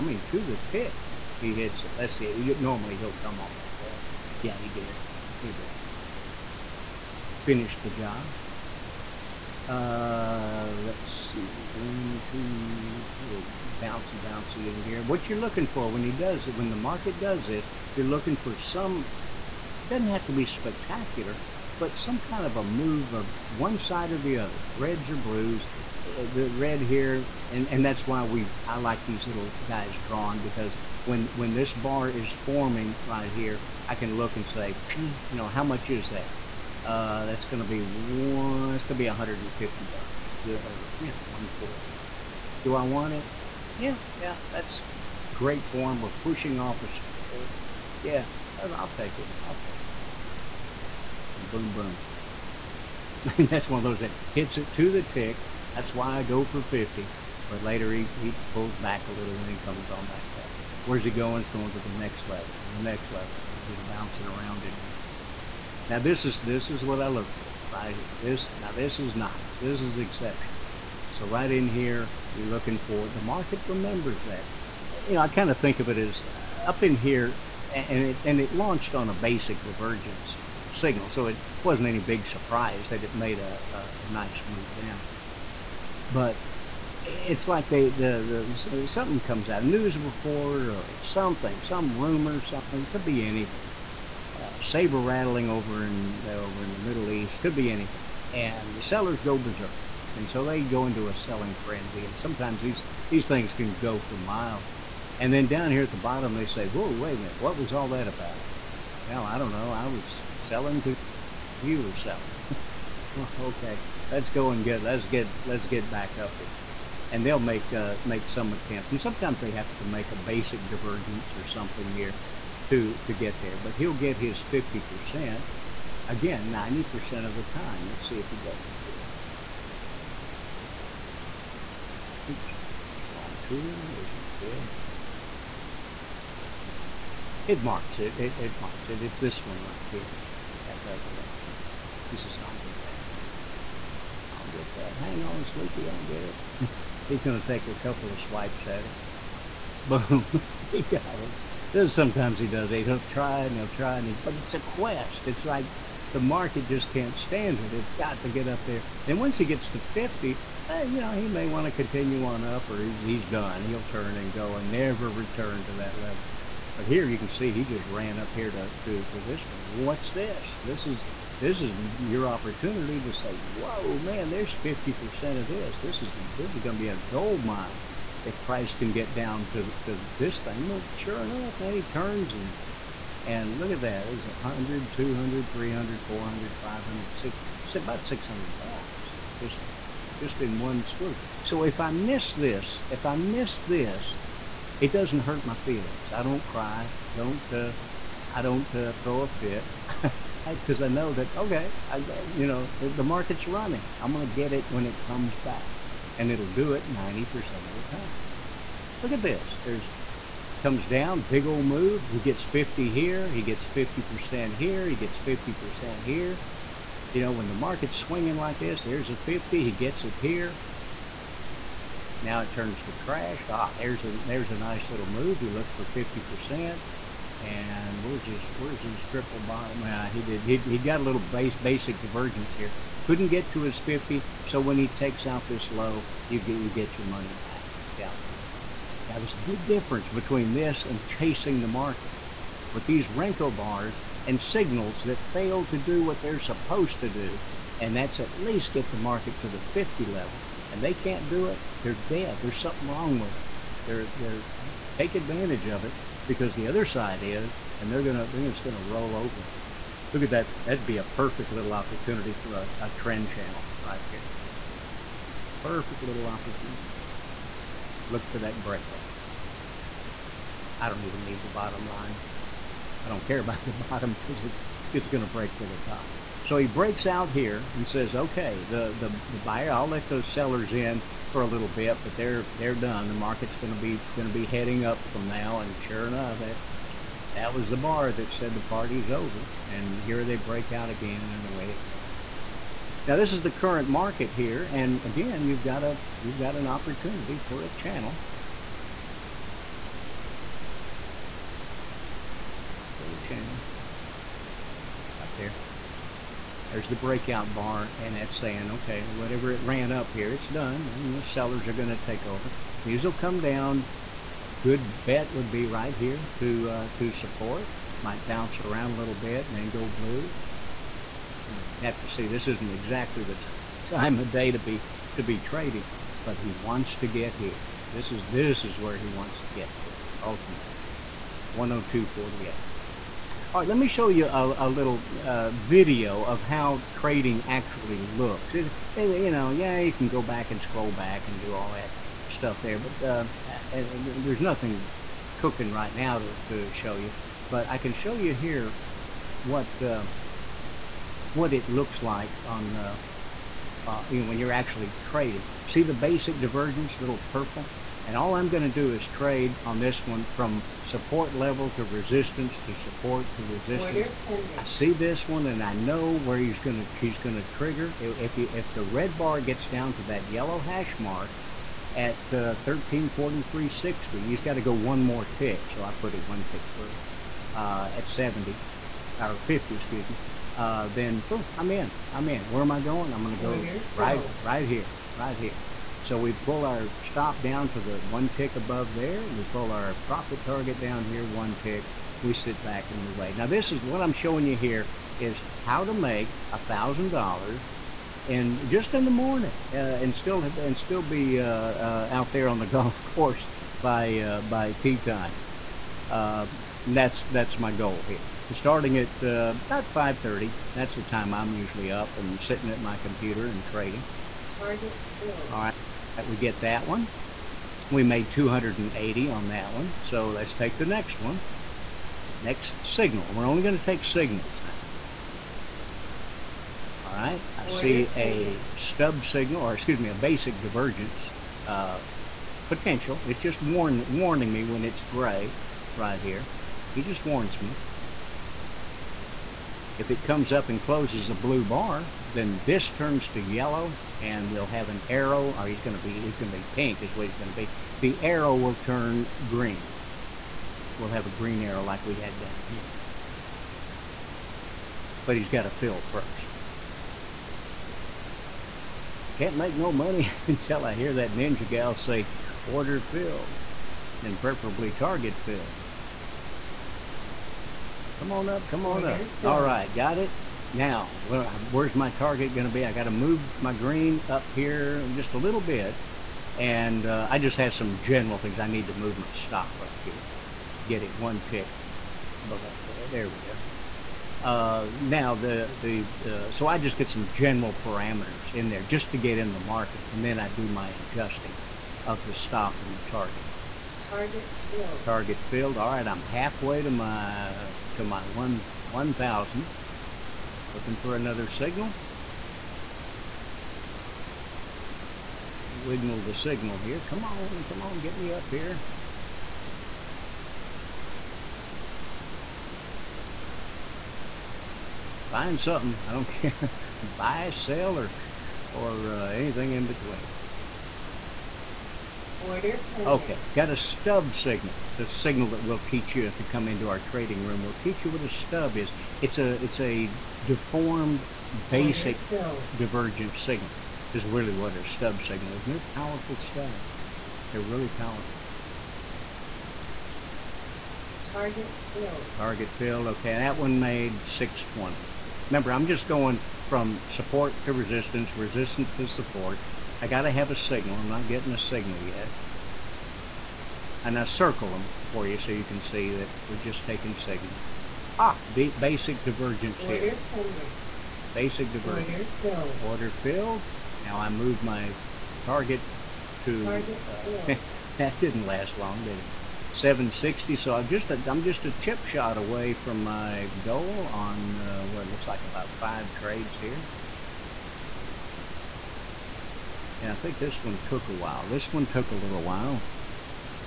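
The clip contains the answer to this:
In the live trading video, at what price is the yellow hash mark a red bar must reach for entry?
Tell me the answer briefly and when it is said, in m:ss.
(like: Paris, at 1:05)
1343.60, at 6:12.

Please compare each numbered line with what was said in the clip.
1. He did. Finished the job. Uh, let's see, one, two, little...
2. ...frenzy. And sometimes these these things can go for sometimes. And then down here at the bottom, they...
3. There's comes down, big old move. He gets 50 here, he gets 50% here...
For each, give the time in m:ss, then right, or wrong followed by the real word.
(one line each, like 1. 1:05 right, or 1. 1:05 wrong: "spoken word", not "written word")
1. 0:05 right
2. 1:41 wrong: "miles", not "sometimes"
3. 3:29 right.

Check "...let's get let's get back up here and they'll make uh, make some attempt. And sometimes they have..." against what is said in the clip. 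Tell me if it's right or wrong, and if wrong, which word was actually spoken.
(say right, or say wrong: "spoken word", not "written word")
right.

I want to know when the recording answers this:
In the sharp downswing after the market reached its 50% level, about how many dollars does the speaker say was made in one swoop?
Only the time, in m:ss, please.
3:07.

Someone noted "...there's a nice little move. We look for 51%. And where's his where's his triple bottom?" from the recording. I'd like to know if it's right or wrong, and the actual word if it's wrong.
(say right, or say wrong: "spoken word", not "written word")
wrong: "50", not "51".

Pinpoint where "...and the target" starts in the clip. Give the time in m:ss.
8:12.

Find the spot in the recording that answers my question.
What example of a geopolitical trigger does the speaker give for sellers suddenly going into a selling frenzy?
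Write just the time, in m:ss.
1:34.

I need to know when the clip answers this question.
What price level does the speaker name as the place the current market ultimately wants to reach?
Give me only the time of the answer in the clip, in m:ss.
5:31.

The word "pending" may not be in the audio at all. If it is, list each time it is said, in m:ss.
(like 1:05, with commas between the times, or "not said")
8:42, 9:20.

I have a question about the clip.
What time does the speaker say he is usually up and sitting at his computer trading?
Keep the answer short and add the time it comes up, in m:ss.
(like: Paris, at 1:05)
5:30, at 6:49.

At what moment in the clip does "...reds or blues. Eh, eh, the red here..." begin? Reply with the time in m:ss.
0:24.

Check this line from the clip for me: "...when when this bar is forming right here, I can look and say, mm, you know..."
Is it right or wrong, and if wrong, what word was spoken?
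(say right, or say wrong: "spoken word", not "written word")
right.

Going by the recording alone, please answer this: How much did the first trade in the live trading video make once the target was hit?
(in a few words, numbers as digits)
280.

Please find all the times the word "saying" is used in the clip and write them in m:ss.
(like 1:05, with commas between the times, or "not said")
5:08.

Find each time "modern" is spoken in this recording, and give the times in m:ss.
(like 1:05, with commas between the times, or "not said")
not said.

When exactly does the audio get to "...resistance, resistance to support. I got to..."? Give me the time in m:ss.
9:07.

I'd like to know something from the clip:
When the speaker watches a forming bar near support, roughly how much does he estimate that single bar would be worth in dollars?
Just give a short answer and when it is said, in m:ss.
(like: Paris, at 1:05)
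150, at 0:39.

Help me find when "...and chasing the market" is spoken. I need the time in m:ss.
4:00.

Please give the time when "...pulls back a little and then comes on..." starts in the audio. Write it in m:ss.
0:58.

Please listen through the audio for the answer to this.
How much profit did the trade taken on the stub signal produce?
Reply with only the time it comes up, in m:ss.
9:04.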